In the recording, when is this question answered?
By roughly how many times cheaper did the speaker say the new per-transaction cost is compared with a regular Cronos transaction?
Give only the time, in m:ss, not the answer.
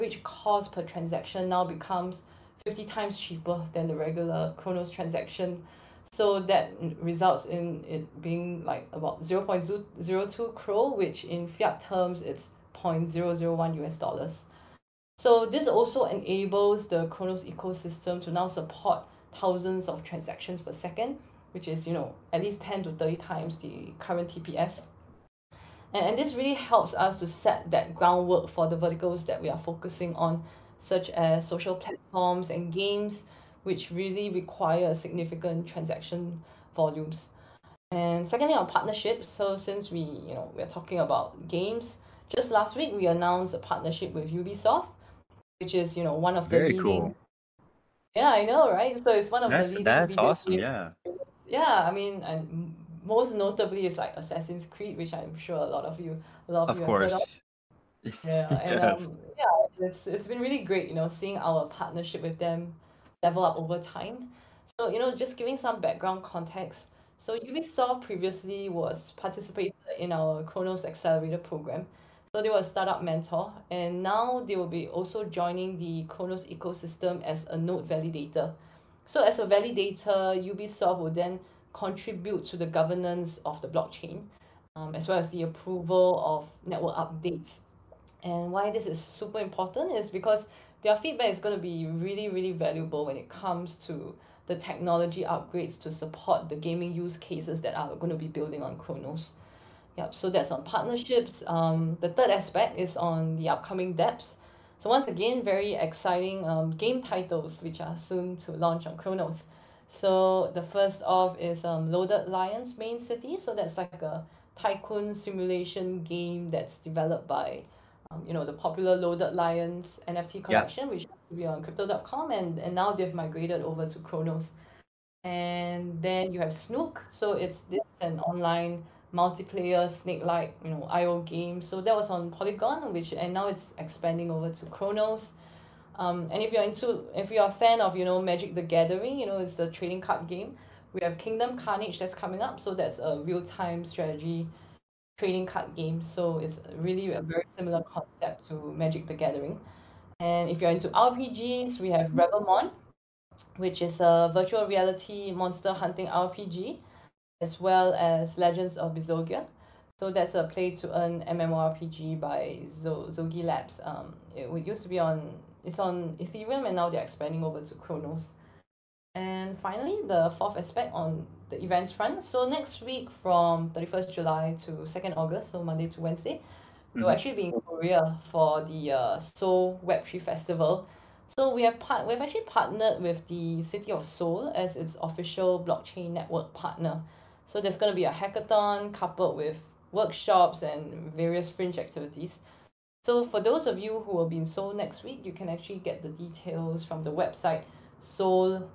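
0:02.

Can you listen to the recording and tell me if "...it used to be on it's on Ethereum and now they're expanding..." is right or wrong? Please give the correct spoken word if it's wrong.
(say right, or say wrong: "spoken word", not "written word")
right.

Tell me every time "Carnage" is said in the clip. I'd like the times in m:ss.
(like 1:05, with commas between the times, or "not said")
2:21.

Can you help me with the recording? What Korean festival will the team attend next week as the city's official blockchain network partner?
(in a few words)
Seoul Web3 Festival.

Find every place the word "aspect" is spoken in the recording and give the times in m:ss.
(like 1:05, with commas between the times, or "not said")
1:42, 2:50.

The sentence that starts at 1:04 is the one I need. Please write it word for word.
So you know, just giving some background context.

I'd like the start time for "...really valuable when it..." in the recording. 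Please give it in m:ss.
1:32.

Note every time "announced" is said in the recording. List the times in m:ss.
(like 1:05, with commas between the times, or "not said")
0:43.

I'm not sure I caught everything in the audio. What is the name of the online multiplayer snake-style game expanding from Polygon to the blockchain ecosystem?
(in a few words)
Snook.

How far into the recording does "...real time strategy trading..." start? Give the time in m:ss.
2:23.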